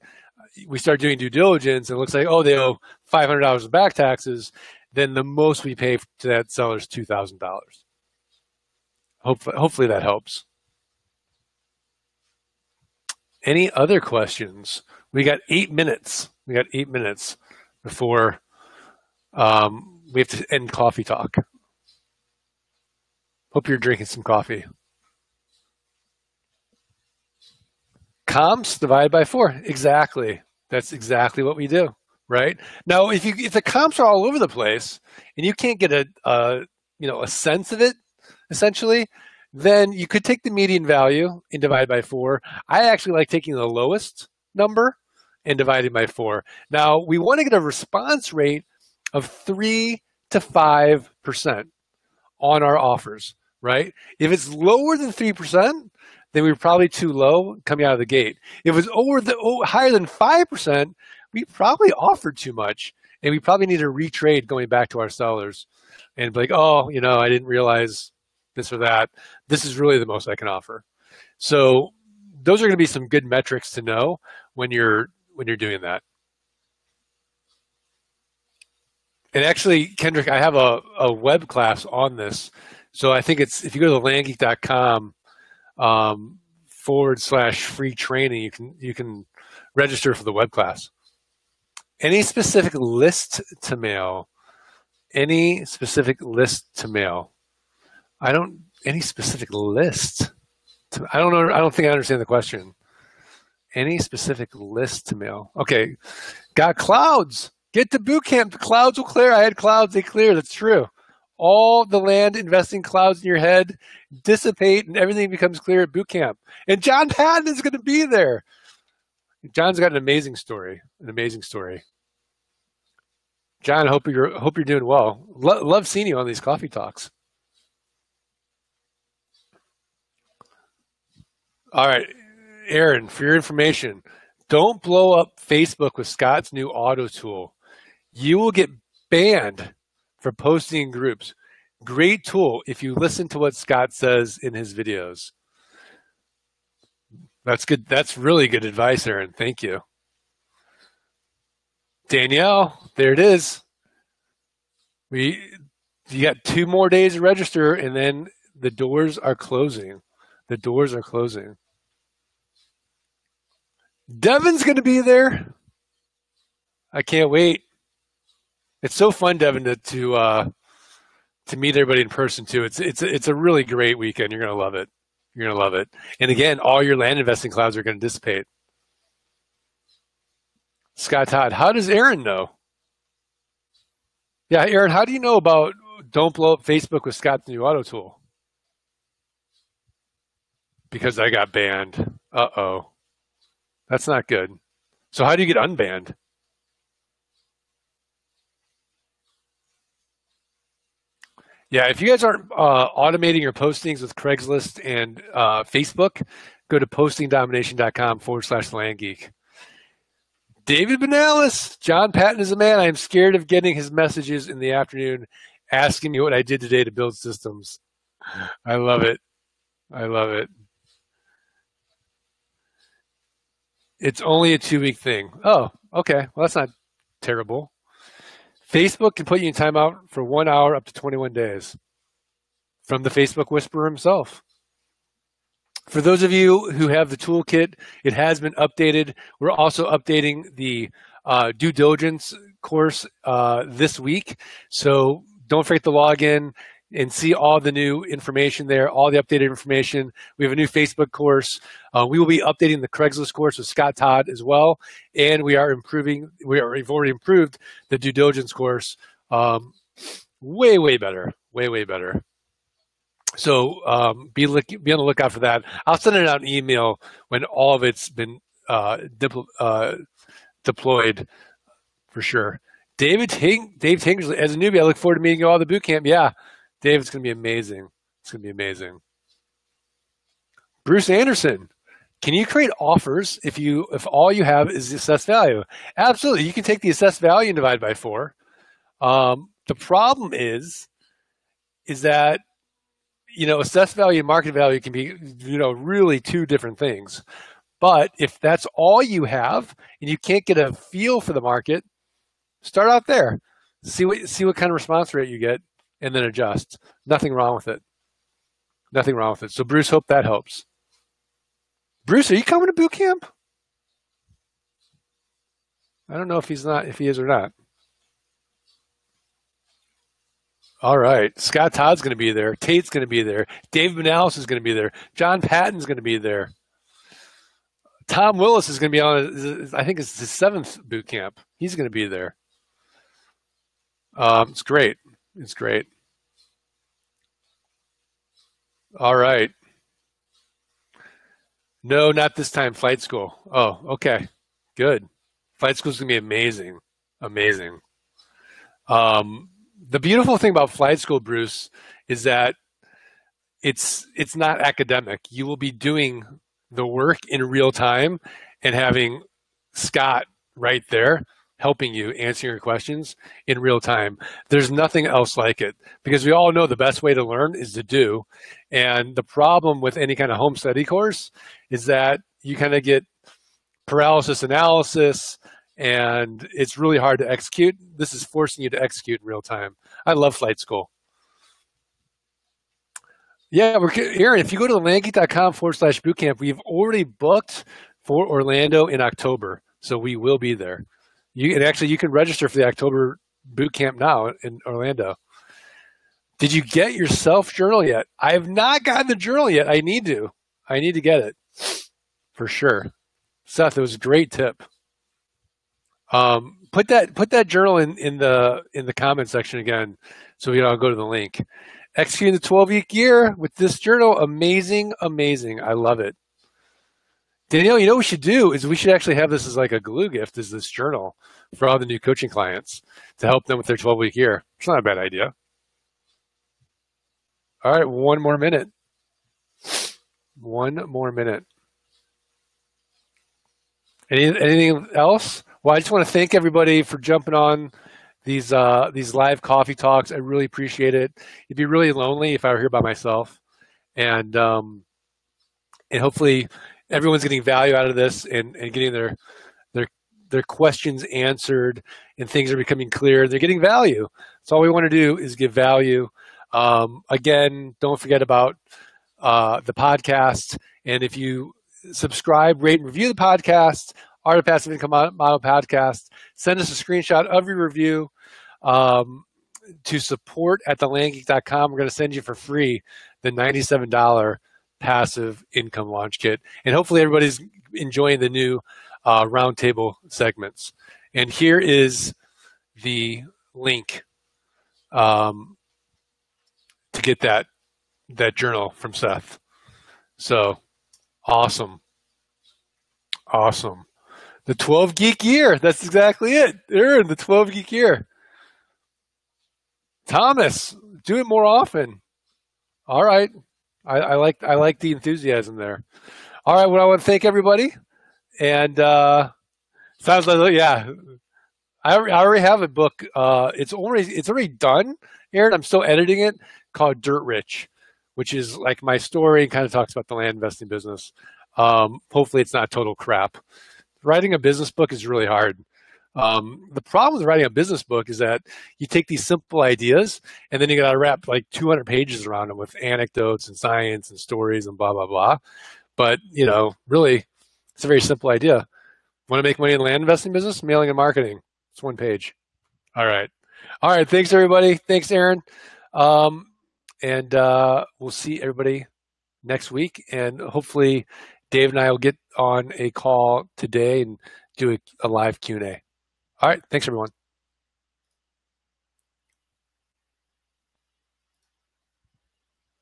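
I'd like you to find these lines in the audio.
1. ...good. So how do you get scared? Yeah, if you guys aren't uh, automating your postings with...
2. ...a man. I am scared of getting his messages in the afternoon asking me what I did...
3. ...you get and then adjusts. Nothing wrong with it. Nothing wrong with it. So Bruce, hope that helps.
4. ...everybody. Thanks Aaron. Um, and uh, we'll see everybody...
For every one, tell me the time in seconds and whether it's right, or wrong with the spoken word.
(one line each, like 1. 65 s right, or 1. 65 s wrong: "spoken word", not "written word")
1. 194 s wrong: "unbanned", not "scared"
2. 212 s right
3. 305 s right
4. 544 s right.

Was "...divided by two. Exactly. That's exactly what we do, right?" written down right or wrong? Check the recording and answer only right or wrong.
wrong.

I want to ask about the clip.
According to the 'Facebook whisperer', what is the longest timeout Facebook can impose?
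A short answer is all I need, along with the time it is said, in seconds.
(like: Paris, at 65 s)
21 days, at 230 s.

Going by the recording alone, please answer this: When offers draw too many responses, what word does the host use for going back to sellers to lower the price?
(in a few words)
retrade.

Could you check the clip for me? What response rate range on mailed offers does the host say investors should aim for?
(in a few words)
3 to 5%.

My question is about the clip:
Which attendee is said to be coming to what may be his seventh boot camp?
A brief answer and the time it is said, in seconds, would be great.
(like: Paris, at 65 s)
Tom Willis, at 328 s.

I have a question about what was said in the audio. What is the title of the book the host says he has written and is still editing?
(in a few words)
Dirt Rich.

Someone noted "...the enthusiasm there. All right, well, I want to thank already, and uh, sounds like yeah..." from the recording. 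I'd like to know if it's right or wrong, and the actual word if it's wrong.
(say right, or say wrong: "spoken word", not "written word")
wrong: "everybody", not "already".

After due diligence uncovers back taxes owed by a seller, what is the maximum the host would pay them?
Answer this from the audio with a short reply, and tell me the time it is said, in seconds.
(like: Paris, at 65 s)
$2,000, at 6 s.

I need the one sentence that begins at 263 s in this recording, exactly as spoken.
So um, be, look, be on the lookout for that.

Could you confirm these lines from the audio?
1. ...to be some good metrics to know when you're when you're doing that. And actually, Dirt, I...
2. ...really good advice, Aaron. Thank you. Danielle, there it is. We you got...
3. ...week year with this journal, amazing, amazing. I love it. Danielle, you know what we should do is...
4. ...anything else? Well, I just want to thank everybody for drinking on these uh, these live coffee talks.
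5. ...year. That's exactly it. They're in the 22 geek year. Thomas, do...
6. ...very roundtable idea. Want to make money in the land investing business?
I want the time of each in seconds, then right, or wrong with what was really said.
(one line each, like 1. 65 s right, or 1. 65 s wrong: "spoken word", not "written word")
1. 72 s wrong: "Kendrick", not "Dirt"
2. 148 s right
3. 412 s right
4. 434 s wrong: "jumping", not "drinking"
5. 495 s wrong: "12", not "22"
6. 537 s wrong: "simple", not "roundtable".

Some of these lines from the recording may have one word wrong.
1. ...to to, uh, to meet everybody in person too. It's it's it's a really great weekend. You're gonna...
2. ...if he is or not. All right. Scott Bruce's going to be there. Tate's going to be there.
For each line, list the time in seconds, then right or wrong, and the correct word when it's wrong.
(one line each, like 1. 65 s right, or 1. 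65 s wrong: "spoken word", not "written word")
1. 169 s right
2. 316 s wrong: "Todd", not "Bruce".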